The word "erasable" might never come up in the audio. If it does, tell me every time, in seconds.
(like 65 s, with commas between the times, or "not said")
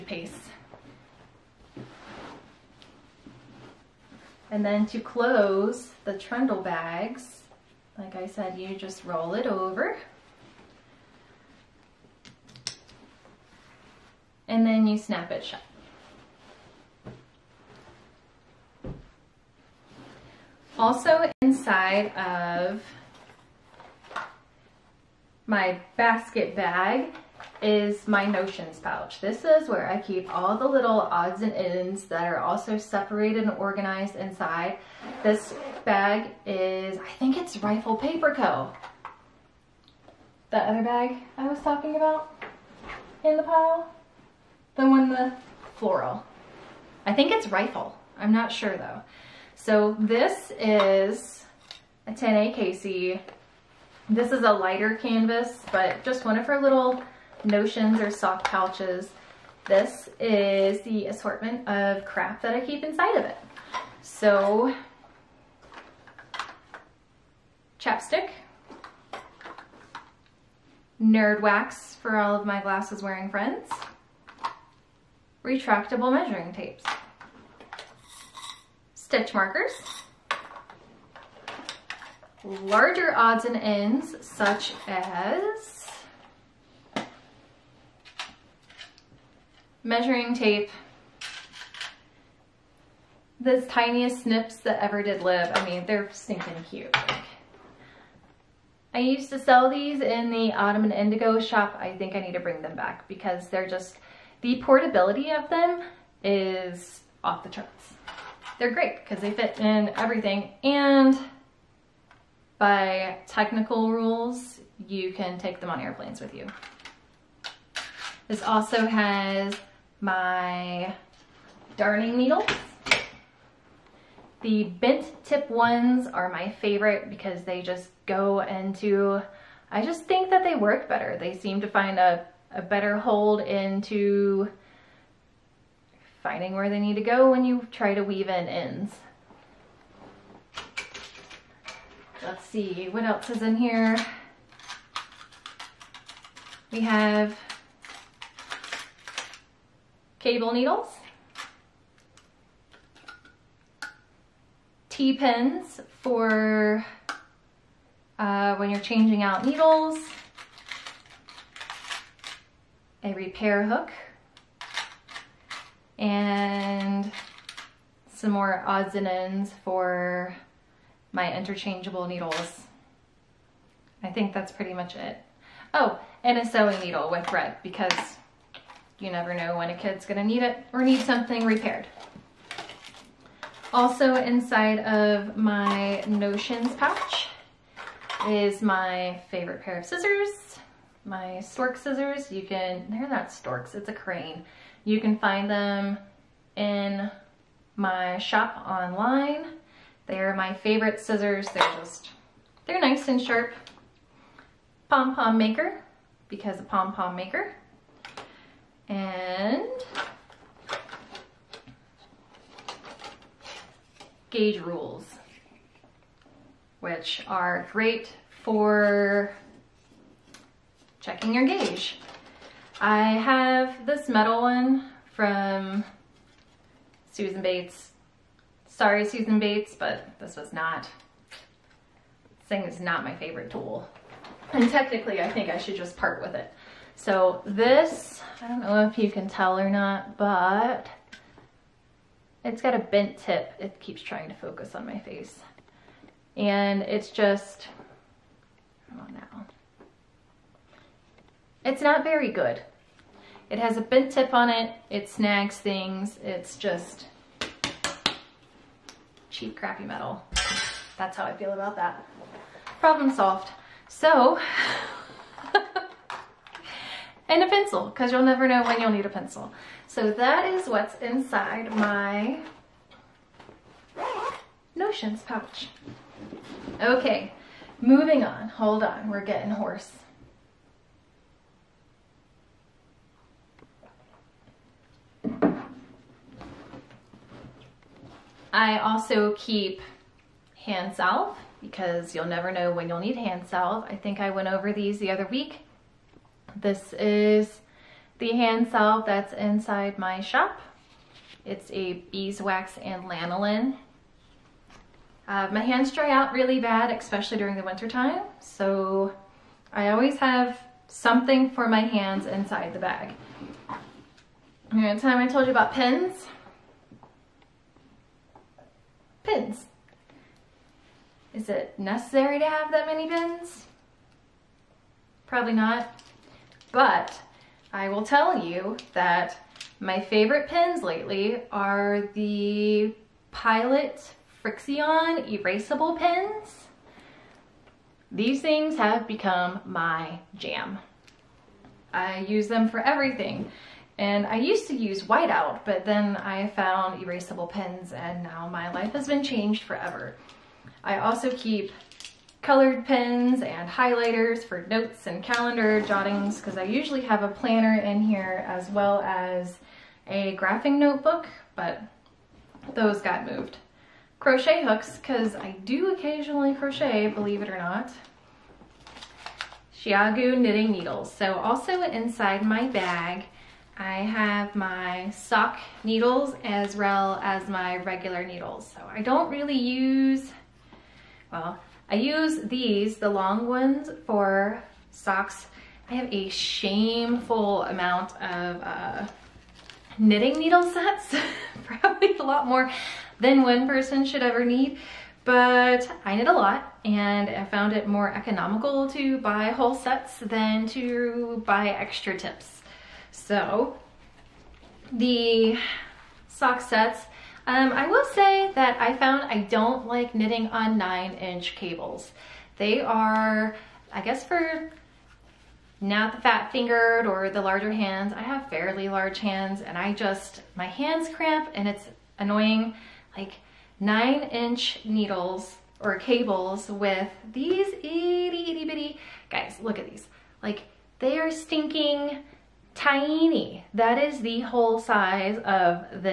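335 s, 347 s.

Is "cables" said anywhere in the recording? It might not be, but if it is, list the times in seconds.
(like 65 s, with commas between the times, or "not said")
150 s, 411 s, 425 s.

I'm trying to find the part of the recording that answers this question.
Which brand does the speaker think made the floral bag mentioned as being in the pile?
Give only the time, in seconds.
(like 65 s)
37 s.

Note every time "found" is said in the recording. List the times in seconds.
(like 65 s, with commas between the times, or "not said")
346 s, 397 s, 408 s.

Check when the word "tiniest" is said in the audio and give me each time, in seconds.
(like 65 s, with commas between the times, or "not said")
93 s.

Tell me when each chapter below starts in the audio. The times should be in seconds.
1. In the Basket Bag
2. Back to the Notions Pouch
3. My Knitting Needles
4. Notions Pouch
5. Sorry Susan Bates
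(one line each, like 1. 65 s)
1. 282 s
2. 260 s
3. 364 s
4. 18 s
5. 219 s.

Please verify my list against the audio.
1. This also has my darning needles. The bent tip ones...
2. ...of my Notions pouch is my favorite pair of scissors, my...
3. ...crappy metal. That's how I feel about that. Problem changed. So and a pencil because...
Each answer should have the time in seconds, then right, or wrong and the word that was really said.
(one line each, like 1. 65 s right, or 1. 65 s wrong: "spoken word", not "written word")
1. 118 s right
2. 184 s right
3. 259 s wrong: "solved", not "changed".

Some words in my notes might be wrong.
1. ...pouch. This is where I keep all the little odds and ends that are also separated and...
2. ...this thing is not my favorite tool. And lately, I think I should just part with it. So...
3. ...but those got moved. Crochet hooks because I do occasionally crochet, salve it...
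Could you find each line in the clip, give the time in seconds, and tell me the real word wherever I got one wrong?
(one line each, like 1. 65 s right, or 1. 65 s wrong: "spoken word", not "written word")
1. 28 s right
2. 231 s wrong: "technically", not "lately"
3. 361 s wrong: "believe", not "salve".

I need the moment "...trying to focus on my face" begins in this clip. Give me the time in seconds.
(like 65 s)
244 s.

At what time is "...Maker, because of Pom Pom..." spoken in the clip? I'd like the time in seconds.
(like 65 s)
205 s.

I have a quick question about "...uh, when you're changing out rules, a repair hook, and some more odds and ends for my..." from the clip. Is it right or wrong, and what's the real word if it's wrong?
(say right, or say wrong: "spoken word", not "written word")
wrong: "needles", not "rules".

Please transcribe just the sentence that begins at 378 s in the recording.
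So I don't really use, well, I use these, the long ones, for socks.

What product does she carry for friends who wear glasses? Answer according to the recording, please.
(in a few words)
Nerd wax.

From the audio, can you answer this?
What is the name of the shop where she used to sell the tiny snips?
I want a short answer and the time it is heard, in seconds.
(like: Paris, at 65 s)
Ottoman Indigo, at 100 s.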